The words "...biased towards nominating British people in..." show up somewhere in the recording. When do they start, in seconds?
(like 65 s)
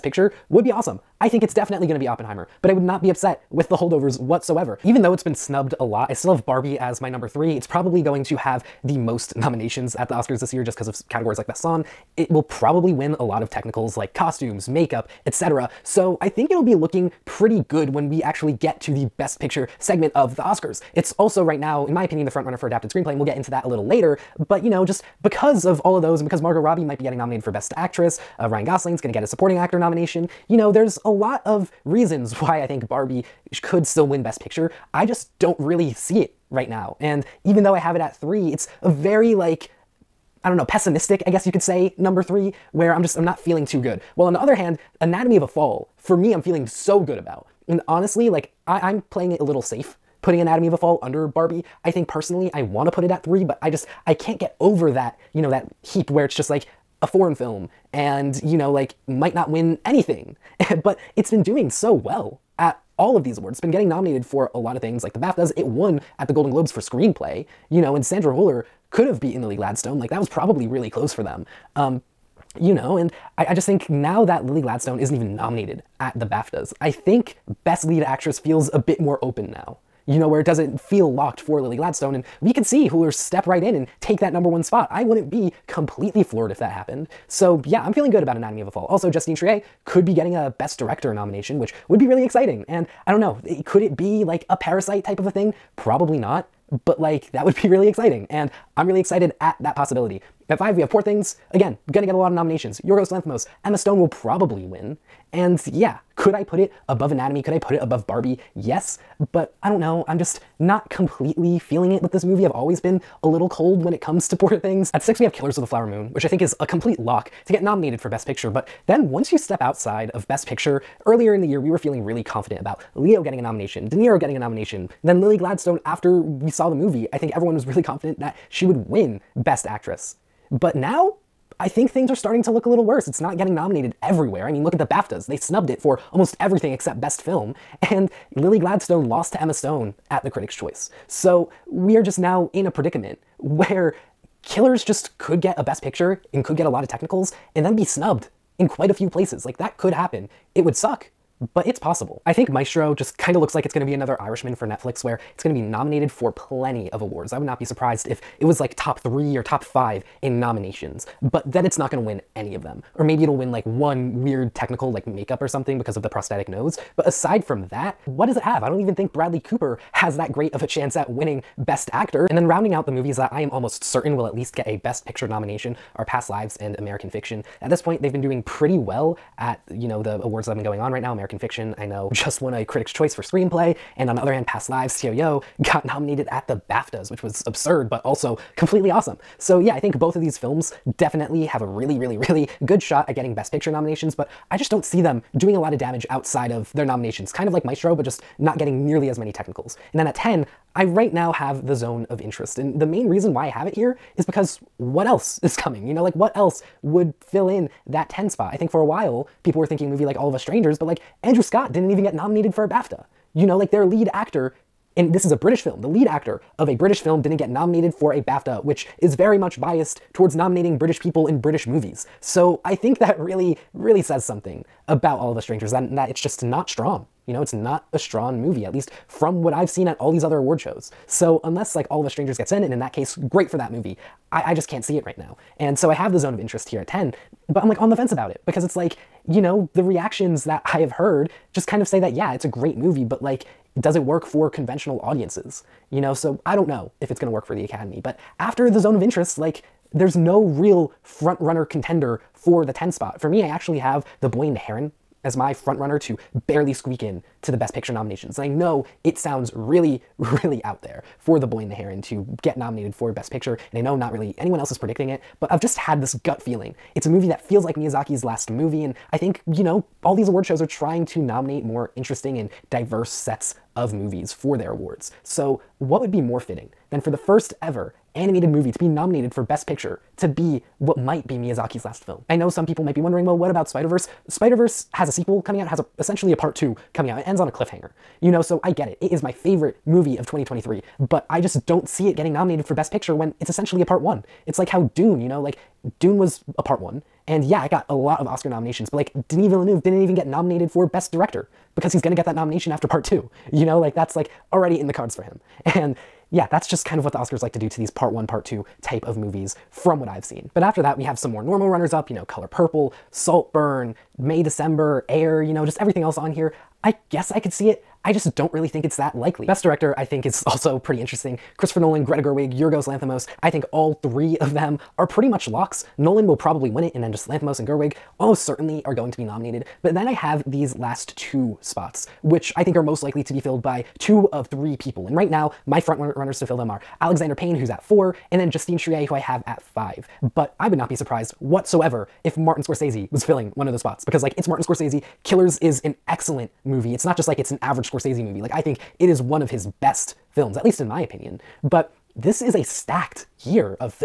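219 s.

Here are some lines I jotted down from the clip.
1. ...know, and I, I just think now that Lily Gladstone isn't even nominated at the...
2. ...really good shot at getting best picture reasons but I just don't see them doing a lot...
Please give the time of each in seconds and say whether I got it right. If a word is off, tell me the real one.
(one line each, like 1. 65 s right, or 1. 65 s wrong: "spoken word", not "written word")
1. 72 s right
2. 192 s wrong: "nominations", not "reasons".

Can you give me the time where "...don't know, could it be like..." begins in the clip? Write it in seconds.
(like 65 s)
93 s.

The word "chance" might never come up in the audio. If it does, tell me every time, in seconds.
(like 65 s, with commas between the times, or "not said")
170 s.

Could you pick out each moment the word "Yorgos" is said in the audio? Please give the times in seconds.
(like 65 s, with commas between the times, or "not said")
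102 s, 322 s.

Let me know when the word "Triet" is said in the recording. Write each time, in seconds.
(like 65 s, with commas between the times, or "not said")
89 s, 338 s.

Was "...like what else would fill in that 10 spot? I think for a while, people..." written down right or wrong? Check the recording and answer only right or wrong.
right.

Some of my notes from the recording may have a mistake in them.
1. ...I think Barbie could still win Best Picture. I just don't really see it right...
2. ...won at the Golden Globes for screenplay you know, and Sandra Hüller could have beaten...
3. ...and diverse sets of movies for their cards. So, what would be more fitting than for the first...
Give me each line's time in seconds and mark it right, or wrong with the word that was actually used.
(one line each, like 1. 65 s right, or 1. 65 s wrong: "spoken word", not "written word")
1. 32 s right
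2. 65 s right
3. 272 s wrong: "awards", not "cards".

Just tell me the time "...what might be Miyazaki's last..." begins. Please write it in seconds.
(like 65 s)
280 s.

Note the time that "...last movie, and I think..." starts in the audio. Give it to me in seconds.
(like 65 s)
268 s.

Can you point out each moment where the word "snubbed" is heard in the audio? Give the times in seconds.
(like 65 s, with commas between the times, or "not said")
5 s, 135 s, 147 s.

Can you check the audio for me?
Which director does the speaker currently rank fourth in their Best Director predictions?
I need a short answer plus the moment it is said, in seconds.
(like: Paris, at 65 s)
Alexander Payne, at 337 s.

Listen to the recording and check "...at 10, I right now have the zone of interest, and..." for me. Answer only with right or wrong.
right.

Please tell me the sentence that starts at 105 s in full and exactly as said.
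And yeah, could I put it above Anatomy?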